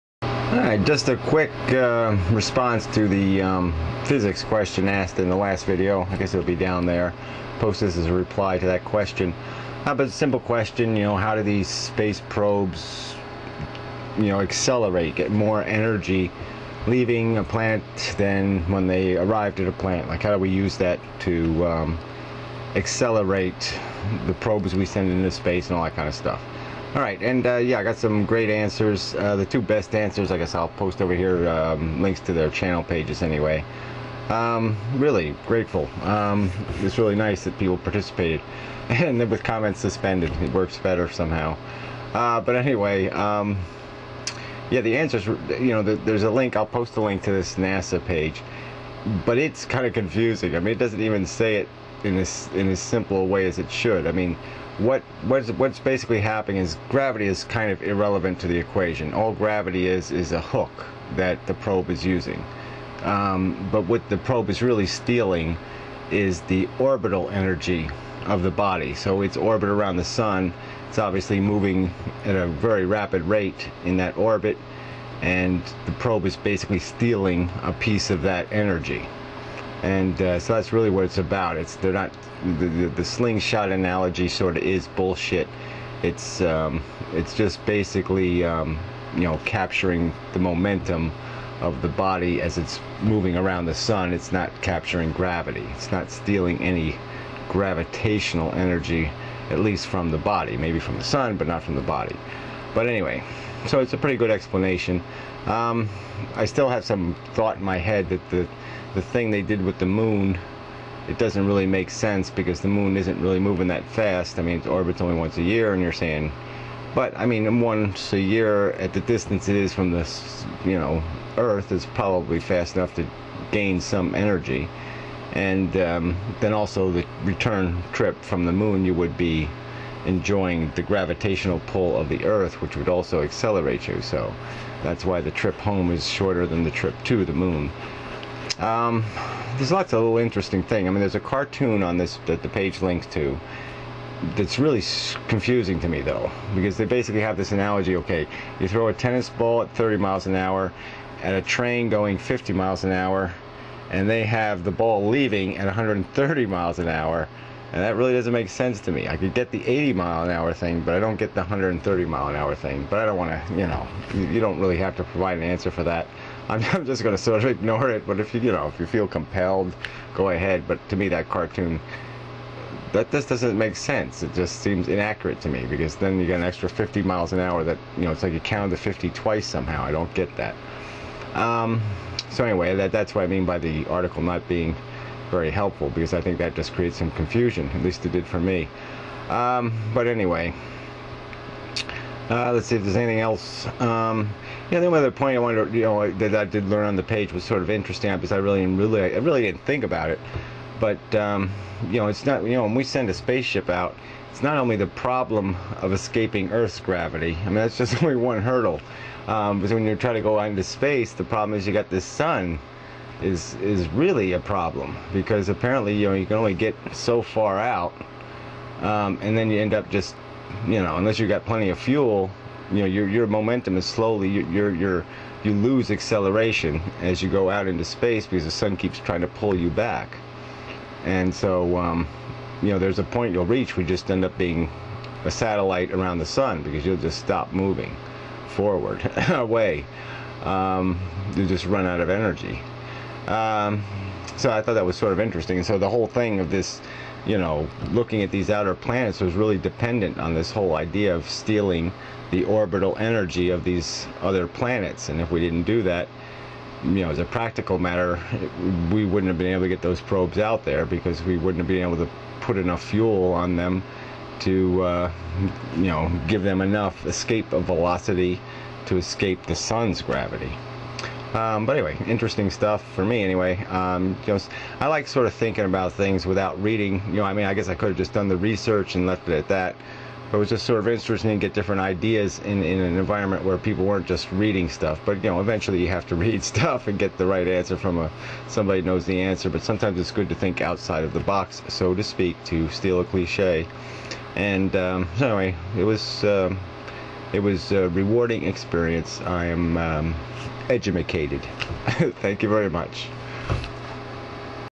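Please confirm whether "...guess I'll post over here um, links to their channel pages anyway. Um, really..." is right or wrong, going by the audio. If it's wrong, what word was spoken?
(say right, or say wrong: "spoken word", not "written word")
right.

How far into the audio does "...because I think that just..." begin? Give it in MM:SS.
03:05.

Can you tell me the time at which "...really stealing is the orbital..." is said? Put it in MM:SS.
01:04.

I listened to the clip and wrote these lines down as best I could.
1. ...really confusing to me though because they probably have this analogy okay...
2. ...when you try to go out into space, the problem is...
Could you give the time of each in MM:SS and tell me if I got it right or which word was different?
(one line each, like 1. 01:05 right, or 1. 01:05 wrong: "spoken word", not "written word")
1. 02:24 wrong: "basically", not "probably"
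2. 03:29 right.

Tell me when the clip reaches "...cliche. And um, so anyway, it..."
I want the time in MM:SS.
04:53.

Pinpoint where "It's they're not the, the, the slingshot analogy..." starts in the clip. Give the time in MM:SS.
01:21.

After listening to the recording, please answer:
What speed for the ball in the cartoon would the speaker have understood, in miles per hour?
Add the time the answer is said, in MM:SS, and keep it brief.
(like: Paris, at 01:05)
80, at 02:39.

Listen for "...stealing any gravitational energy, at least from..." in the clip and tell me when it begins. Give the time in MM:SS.
01:36.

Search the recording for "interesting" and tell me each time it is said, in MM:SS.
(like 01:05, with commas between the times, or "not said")
02:20, 03:17, 04:05, 04:32, 04:40.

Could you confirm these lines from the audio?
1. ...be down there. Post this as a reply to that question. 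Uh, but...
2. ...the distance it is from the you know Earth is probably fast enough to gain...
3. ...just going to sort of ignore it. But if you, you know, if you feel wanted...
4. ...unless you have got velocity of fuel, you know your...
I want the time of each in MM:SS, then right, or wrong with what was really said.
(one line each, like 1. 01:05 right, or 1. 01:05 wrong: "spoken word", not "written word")
1. 00:06 right
2. 01:58 right
3. 02:46 wrong: "compelled", not "wanted"
4. 03:40 wrong: "plenty", not "velocity".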